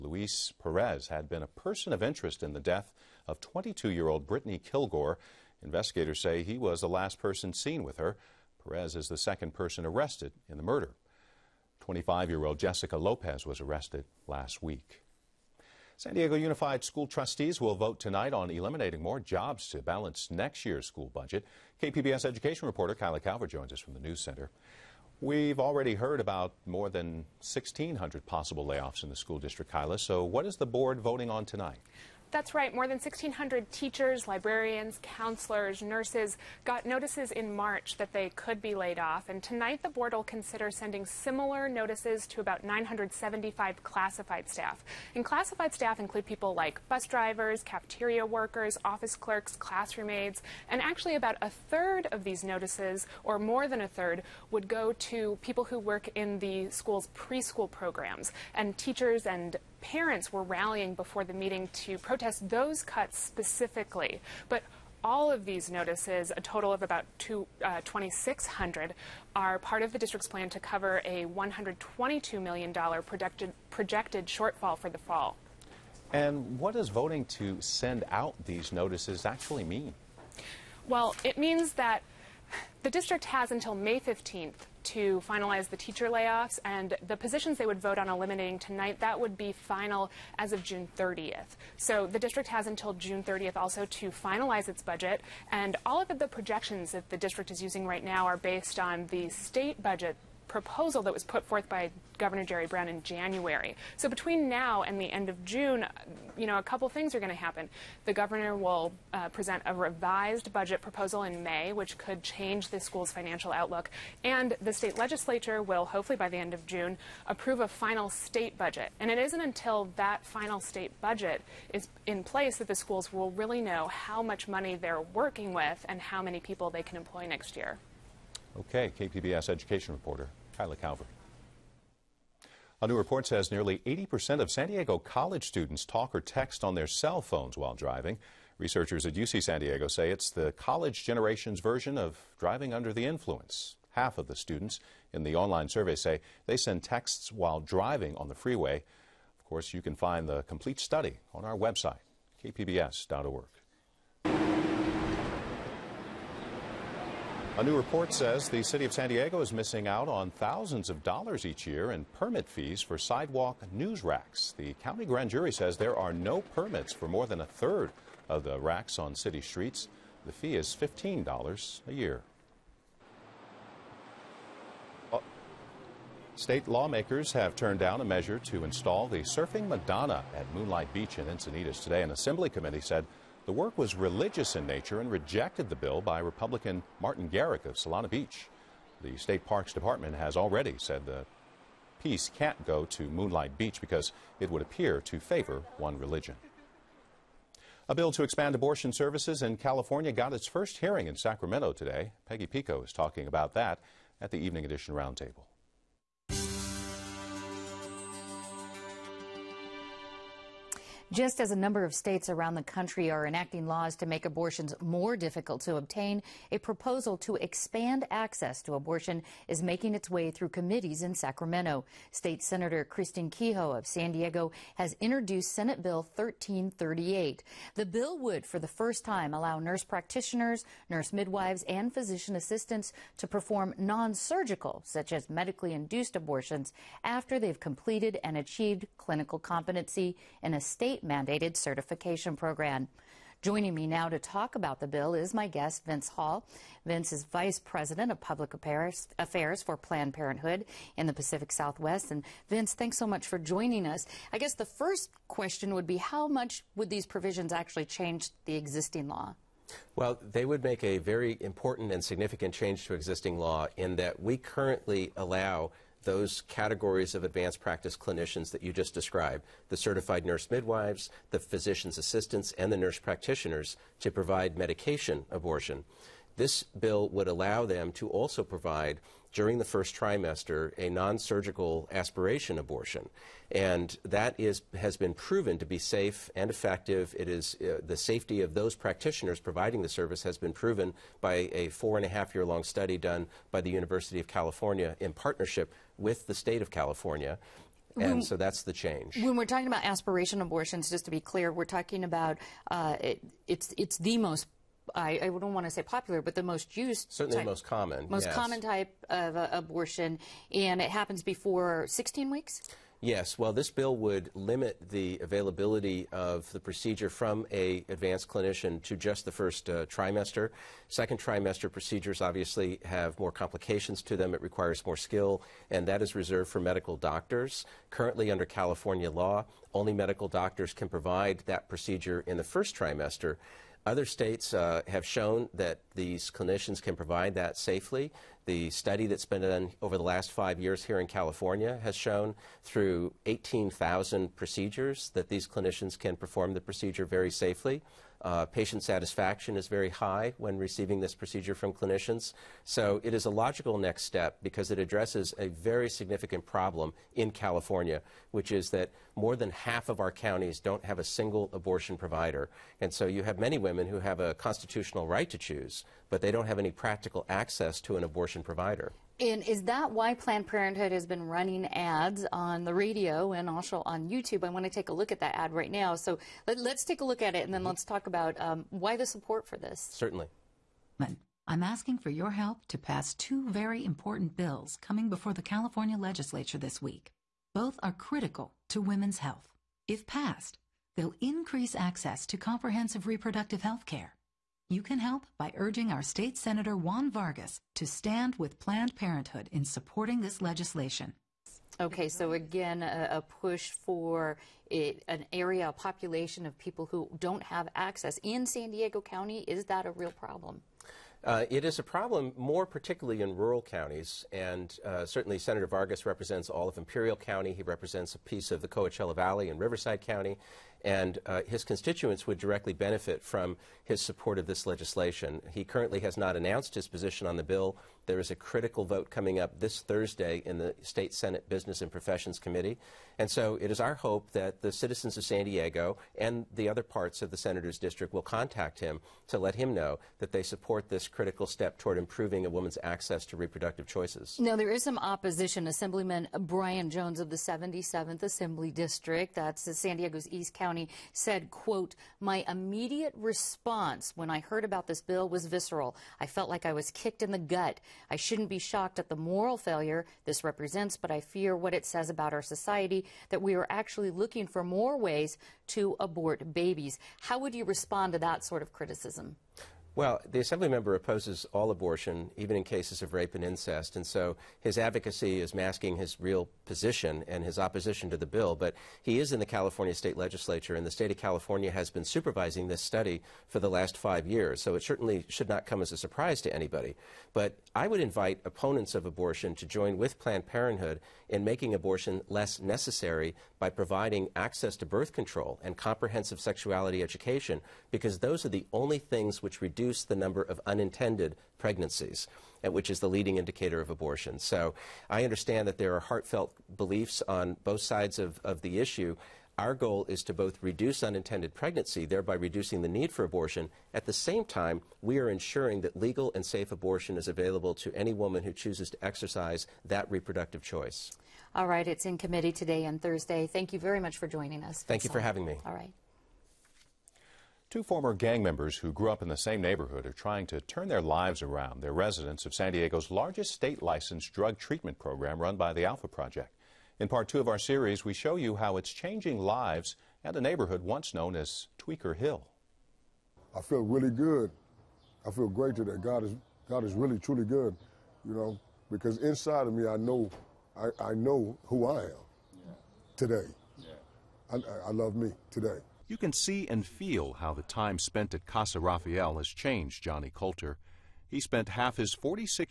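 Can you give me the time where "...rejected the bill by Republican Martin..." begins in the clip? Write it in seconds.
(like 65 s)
185 s.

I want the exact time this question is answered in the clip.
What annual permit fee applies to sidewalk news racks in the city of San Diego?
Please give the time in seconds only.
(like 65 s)
170 s.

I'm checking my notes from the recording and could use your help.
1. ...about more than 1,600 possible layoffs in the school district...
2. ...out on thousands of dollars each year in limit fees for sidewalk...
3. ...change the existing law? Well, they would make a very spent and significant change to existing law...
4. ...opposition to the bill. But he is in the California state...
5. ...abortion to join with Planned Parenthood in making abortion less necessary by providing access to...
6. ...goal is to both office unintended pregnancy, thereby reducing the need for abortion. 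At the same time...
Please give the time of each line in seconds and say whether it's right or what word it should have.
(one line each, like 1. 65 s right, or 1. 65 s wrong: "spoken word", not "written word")
1. 26 s right
2. 159 s wrong: "permit", not "limit"
3. 257 s wrong: "important", not "spent"
4. 477 s right
5. 489 s right
6. 509 s wrong: "reduce", not "office".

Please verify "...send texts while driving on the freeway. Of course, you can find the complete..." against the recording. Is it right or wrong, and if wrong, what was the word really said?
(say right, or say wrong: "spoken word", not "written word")
right.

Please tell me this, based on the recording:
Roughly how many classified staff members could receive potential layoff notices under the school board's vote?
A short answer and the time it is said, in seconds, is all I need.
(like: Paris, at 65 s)
975, at 42 s.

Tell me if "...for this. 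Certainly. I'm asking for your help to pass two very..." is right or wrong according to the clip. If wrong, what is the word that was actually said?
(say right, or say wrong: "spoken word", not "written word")
right.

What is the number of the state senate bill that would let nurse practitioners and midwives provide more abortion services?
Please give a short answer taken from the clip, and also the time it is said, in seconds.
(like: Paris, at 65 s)
Senate Bill 1338, at 225 s.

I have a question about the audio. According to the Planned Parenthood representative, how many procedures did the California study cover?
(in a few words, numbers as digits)
18,000.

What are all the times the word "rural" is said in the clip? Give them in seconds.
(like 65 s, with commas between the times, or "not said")
413 s.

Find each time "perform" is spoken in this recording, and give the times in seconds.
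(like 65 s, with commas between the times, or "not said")
233 s, 346 s.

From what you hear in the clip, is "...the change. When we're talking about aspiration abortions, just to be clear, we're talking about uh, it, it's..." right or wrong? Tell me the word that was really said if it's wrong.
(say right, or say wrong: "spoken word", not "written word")
right.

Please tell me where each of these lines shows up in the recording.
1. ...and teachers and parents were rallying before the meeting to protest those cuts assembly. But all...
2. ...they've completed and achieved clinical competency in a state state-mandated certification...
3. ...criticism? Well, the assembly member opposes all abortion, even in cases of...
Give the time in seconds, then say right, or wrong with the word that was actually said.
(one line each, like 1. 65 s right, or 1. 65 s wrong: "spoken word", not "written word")
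1. 58 s wrong: "specifically", not "assembly"
2. 237 s right
3. 468 s right.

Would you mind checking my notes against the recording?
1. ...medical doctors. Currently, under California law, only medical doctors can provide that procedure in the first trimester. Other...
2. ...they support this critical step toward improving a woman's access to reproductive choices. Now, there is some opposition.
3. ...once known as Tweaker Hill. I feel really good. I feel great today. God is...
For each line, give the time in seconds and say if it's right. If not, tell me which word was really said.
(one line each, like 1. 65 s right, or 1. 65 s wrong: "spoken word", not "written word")
1. 326 s right
2. 440 s right
3. 540 s right.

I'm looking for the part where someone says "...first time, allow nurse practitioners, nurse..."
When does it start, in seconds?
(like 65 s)
228 s.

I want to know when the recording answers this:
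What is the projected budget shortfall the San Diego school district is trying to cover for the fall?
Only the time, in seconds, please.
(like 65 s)
71 s.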